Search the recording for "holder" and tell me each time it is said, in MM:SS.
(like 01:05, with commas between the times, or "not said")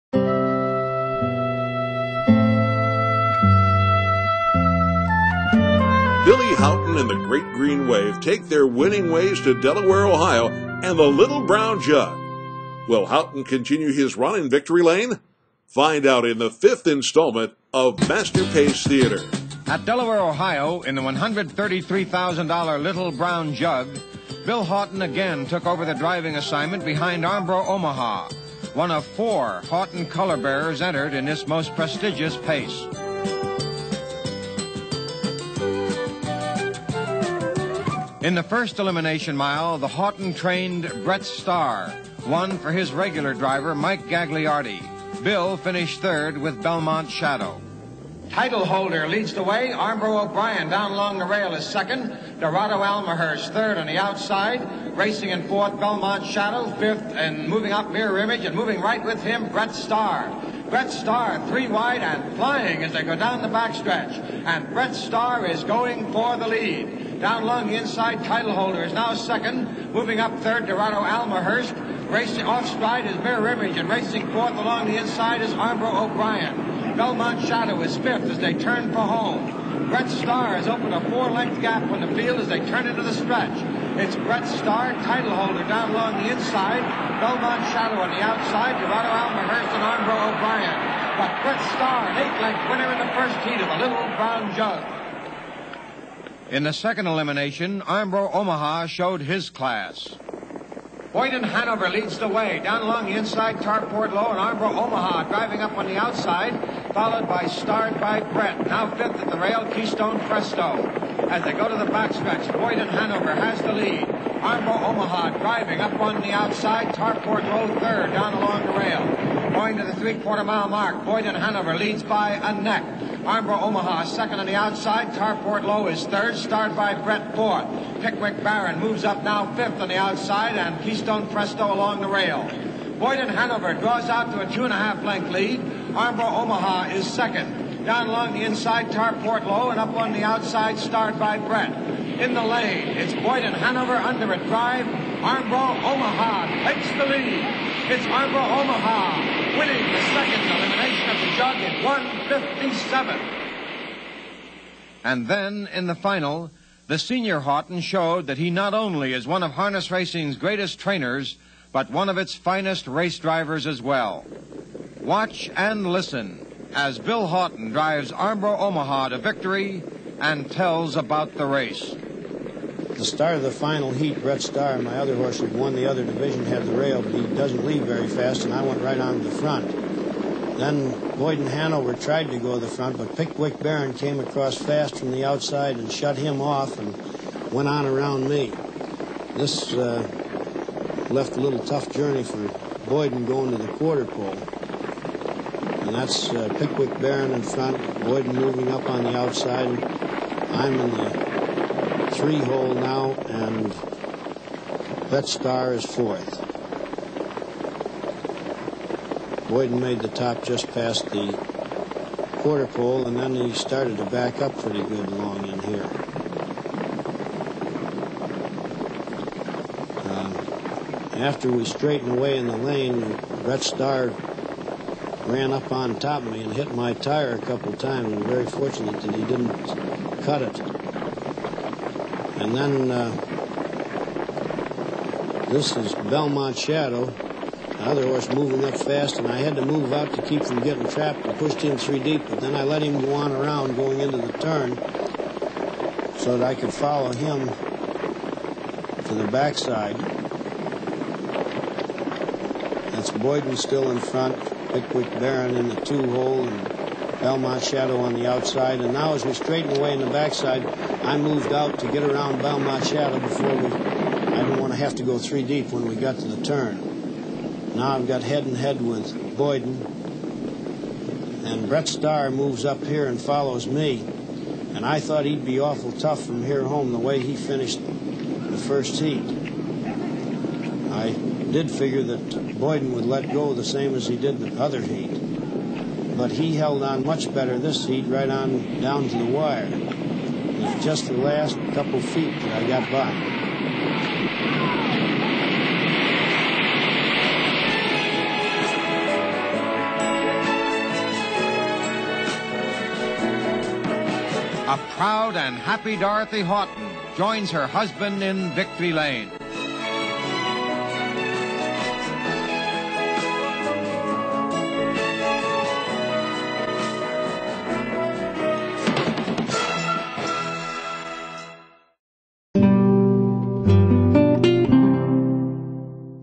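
00:48, 01:08, 01:25.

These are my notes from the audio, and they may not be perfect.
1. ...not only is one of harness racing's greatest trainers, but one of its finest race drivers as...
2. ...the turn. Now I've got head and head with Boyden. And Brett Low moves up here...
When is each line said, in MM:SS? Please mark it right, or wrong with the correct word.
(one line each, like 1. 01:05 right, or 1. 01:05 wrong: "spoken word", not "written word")
1. 02:38 right
2. 04:26 wrong: "Starr", not "Low".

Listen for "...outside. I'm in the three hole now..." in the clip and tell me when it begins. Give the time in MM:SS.
03:19.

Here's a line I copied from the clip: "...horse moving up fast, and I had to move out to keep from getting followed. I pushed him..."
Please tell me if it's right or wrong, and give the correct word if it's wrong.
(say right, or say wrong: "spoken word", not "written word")
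wrong: "trapped", not "followed".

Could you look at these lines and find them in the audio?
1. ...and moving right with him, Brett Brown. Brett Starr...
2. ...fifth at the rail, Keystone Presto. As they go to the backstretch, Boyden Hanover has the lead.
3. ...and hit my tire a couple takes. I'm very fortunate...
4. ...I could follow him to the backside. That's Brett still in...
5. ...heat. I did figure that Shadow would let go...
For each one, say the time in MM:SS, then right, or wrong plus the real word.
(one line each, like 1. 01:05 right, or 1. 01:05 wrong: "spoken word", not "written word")
1. 00:58 wrong: "Starr", not "Brown"
2. 01:48 right
3. 03:46 wrong: "times", not "takes"
4. 04:06 wrong: "Boyden", not "Brett"
5. 04:38 wrong: "Boyden", not "Shadow".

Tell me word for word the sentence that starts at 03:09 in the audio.
This uh, left a little tough journey for Boyden going to the quarter pole.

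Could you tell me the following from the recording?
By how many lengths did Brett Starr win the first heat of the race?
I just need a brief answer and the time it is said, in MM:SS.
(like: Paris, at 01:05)
8, at 01:32.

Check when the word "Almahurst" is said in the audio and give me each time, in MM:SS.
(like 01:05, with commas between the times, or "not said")
00:52, 01:11, 01:29.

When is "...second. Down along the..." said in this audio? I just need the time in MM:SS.
02:17.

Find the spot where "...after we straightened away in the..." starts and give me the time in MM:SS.
03:41.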